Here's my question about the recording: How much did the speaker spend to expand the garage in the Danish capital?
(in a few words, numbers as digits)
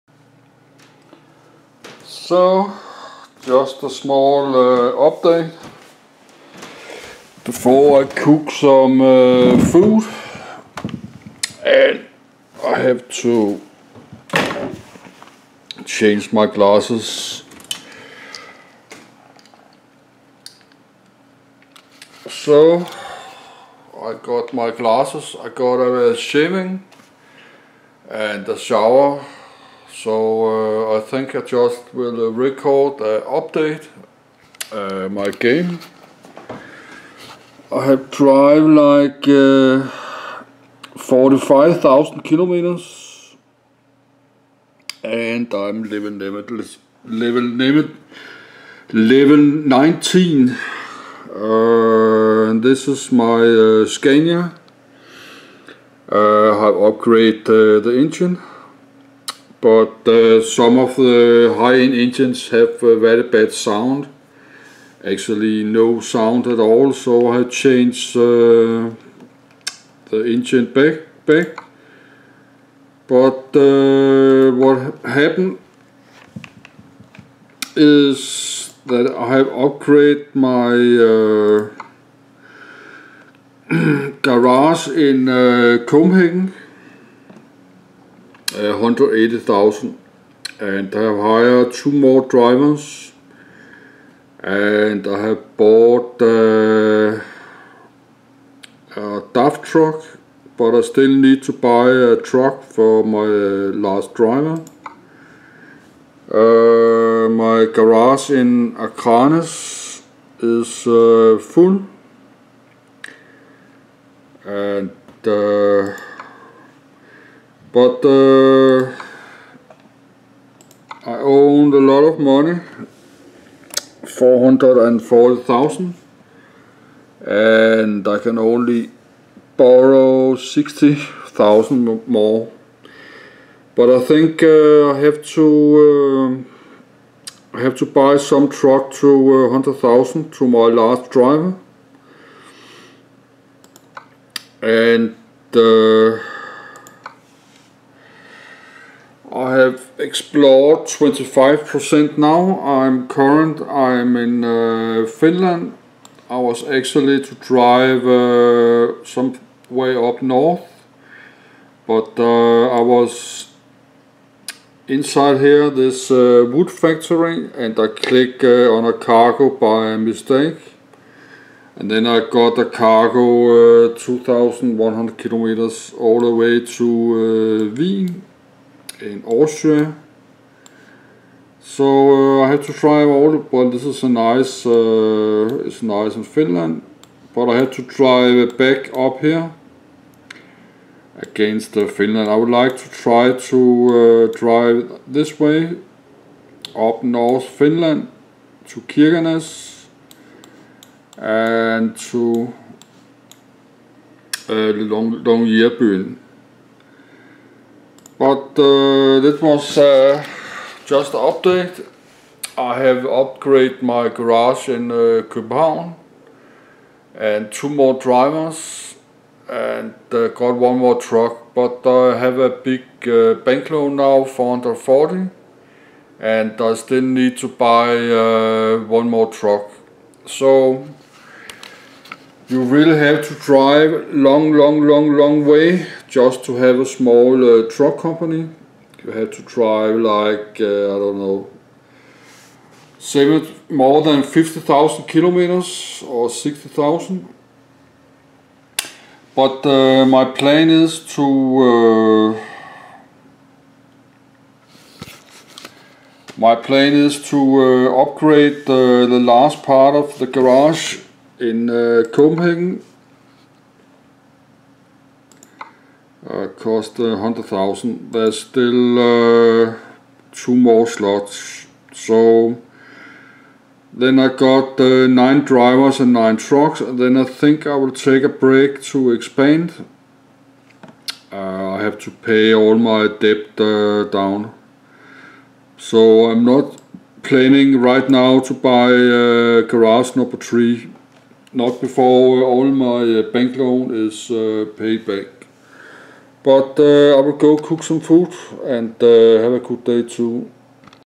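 180,000.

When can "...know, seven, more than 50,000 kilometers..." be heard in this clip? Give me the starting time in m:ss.
4:01.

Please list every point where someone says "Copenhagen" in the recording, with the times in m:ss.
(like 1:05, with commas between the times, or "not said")
1:25, 3:35, 4:22.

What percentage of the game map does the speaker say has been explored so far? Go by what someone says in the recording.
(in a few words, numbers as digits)
25%.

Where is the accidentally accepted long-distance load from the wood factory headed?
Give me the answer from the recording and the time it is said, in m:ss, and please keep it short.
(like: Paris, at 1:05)
Wien, at 2:57.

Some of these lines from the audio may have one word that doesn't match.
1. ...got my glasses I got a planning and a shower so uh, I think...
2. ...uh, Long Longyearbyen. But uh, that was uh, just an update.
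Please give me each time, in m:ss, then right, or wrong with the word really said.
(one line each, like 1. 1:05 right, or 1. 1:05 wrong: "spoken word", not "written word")
1. 0:24 wrong: "shaving", not "planning"
2. 3:24 right.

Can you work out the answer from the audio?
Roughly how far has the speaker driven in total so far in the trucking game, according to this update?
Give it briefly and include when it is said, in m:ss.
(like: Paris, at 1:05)
45,000 kilometers, at 0:40.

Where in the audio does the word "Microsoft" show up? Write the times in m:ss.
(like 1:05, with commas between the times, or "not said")
not said.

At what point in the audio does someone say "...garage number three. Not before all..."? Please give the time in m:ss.
4:49.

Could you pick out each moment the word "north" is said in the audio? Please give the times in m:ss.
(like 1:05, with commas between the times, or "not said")
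2:40, 3:17.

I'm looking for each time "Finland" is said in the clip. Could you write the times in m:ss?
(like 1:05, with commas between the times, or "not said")
2:35, 3:06, 3:11, 3:17.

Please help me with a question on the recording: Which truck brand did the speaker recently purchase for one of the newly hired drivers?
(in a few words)
DAF.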